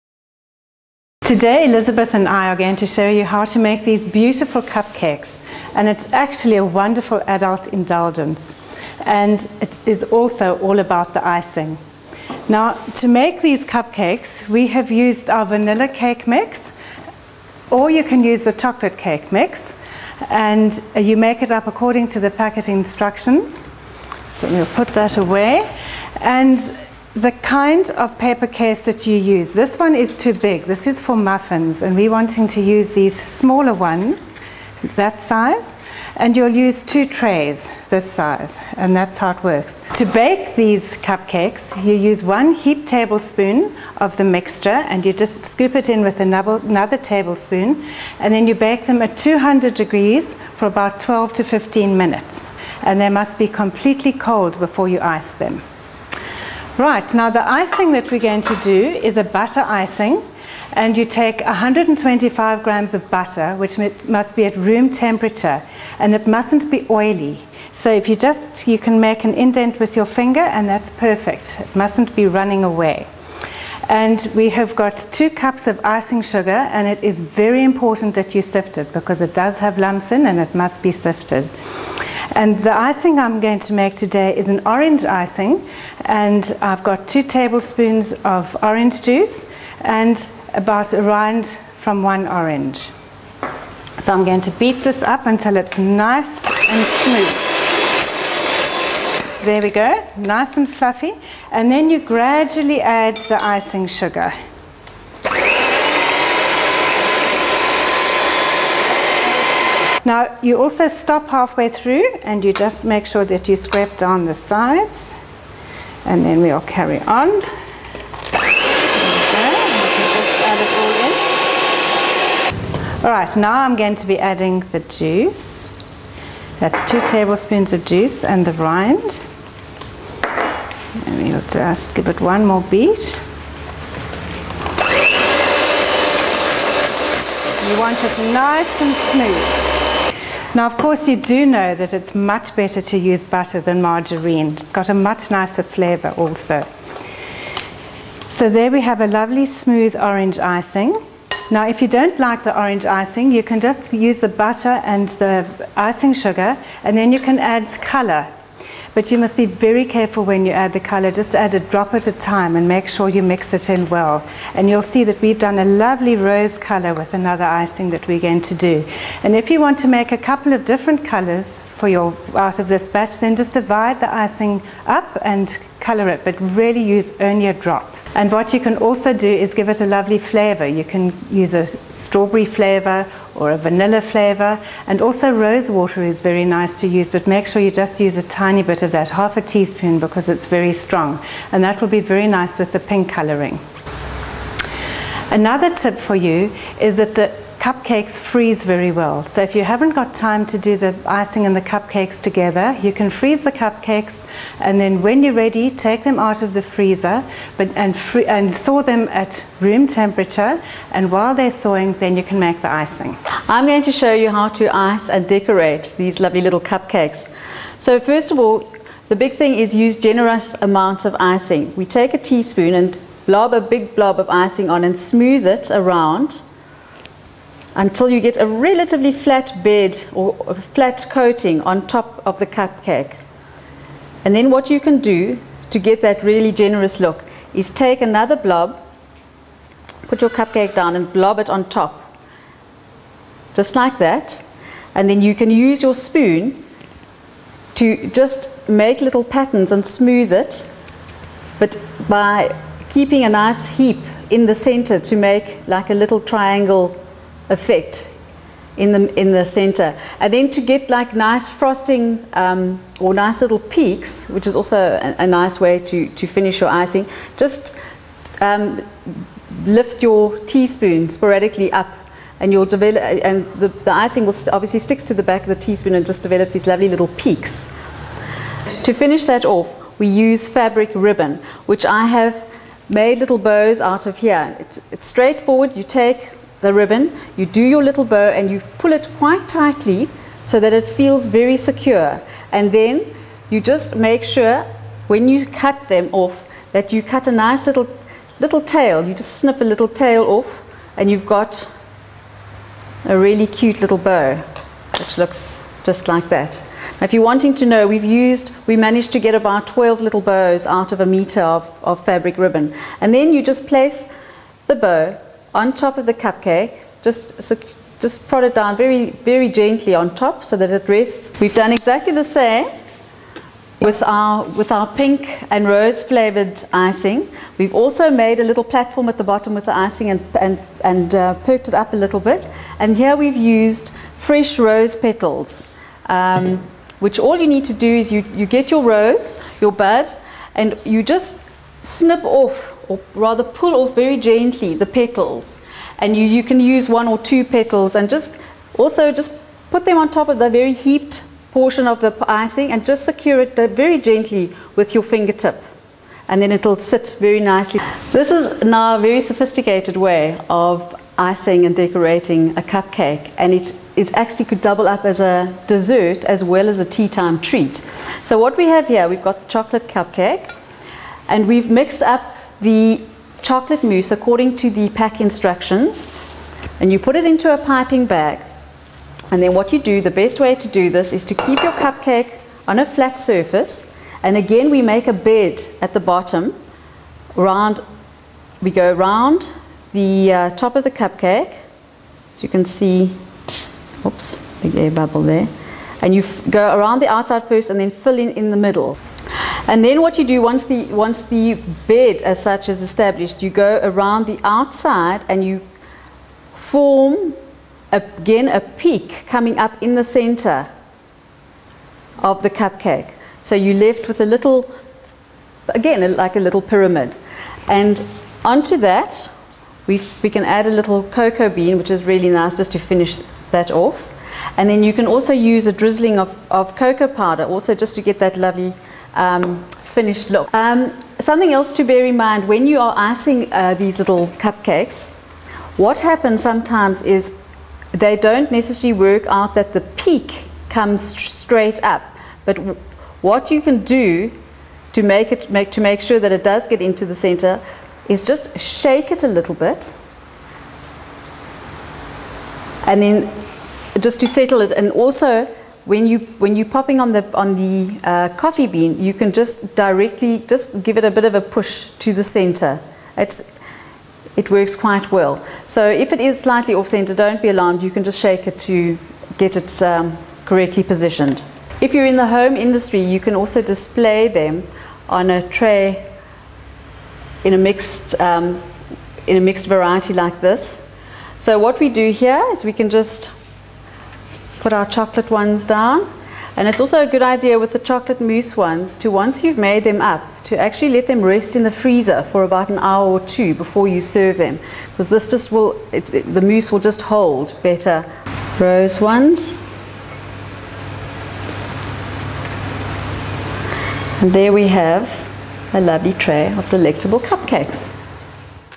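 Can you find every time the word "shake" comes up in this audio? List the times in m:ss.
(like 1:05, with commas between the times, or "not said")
7:28, 7:48.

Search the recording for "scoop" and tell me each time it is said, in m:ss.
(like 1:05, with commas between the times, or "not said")
0:45.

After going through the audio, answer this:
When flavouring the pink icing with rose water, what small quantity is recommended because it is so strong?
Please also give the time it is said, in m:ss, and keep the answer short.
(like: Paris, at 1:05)
half a teaspoon, at 3:09.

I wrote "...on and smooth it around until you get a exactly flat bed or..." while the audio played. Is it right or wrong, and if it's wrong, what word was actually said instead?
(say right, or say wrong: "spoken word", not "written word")
wrong: "relatively", not "exactly".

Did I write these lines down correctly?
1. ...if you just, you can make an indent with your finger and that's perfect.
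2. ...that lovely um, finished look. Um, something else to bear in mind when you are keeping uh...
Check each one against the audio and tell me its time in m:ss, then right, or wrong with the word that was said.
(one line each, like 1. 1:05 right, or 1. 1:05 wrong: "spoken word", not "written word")
1. 1:07 right
2. 7:08 wrong: "icing", not "keeping".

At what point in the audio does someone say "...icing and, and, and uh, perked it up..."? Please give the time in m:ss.
5:29.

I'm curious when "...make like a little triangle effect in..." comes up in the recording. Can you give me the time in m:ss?
4:15.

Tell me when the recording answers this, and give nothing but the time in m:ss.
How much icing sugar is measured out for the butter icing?
1:15.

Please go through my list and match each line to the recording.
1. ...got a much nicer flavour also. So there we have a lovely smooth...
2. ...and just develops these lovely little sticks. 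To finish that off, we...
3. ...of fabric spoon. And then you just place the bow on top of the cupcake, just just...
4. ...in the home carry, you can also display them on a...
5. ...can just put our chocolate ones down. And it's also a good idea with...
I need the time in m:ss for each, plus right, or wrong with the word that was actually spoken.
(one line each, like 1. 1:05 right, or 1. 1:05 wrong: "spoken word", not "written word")
1. 2:24 right
2. 4:35 wrong: "peaks", not "sticks"
3. 5:11 wrong: "ribbon", not "spoon"
4. 7:52 wrong: "industry", not "carry"
5. 8:02 right.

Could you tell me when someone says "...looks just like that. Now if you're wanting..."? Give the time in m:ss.
5:05.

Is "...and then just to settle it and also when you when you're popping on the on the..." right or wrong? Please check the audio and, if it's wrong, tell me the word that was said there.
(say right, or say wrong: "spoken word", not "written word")
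right.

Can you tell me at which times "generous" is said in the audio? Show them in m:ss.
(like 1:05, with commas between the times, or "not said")
3:39, 3:56.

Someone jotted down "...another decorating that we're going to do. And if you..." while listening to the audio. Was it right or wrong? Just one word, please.
wrong.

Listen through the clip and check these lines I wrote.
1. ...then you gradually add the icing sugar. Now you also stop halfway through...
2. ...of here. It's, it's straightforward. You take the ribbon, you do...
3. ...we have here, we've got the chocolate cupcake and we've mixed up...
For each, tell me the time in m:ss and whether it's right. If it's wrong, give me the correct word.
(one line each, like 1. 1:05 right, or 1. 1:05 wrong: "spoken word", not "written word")
1. 1:41 right
2. 4:44 right
3. 6:08 right.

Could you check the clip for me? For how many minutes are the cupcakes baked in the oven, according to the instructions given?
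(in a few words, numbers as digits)
12 to 15 minutes.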